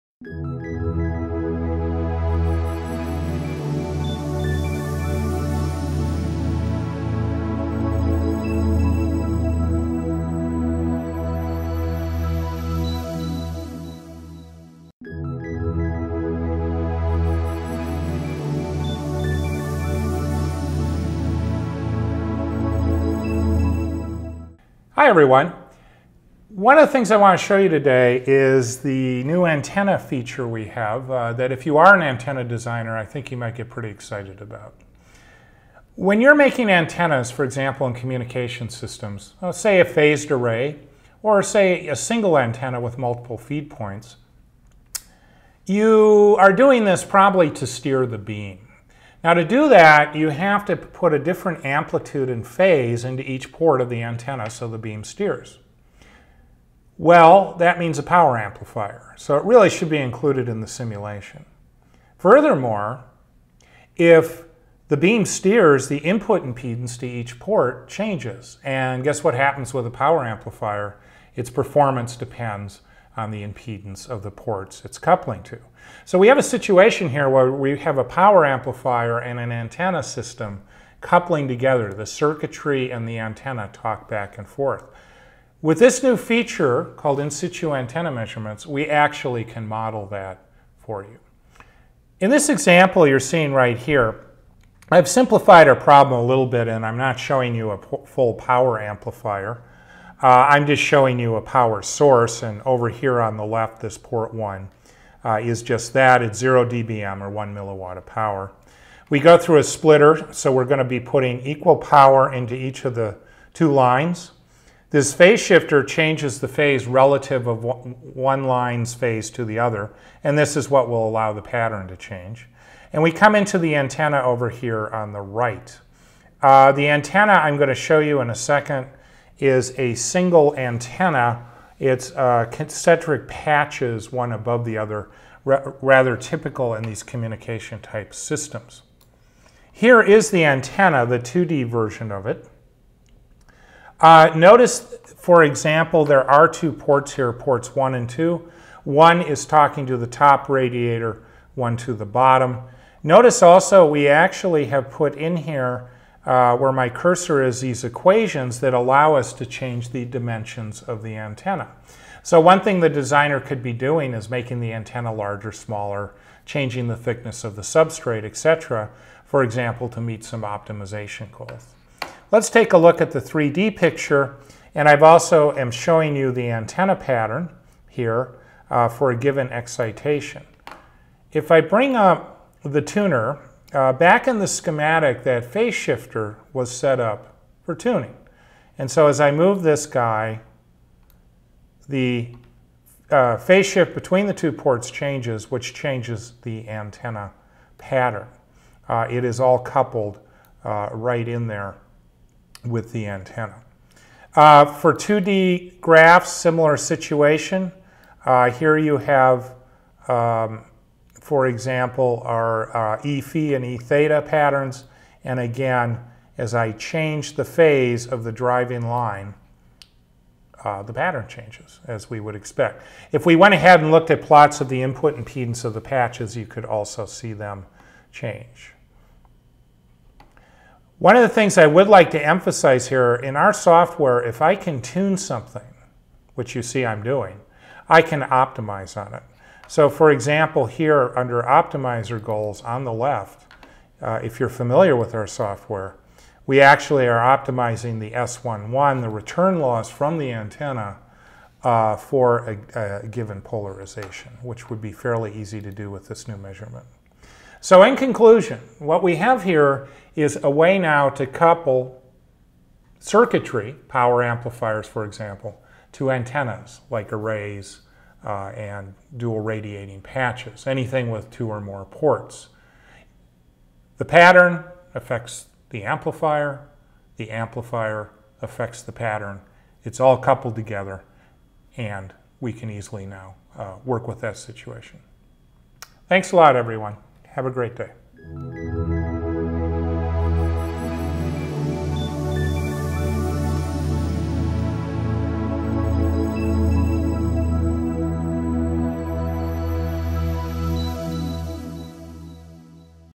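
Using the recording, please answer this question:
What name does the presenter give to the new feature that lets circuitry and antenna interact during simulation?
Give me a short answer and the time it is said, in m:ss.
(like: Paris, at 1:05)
in situ antenna measurements, at 1:27.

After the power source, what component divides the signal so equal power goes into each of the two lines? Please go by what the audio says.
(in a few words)
splitter.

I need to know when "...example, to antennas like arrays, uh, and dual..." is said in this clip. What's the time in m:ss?
4:25.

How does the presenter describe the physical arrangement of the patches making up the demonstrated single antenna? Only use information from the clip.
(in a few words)
concentric patches.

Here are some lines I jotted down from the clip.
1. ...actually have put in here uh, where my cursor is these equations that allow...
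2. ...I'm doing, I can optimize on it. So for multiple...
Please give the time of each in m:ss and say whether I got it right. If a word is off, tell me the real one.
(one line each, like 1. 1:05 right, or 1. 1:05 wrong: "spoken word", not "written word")
1. 2:34 right
2. 3:56 wrong: "example", not "multiple".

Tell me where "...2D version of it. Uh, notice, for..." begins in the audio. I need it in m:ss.
2:21.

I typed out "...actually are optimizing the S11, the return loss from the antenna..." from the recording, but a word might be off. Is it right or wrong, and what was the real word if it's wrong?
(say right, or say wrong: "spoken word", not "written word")
right.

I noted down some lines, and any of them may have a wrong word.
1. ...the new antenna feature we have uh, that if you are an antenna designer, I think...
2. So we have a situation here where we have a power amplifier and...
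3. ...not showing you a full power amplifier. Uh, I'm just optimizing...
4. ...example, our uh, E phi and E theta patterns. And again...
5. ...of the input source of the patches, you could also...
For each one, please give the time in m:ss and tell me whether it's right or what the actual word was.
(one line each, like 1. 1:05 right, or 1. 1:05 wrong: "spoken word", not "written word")
1. 0:28 right
2. 1:16 right
3. 1:36 wrong: "showing", not "optimizing"
4. 3:31 right
5. 3:44 wrong: "impedance", not "source".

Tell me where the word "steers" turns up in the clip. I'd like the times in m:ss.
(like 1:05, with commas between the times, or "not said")
0:47, 0:55, 1:05.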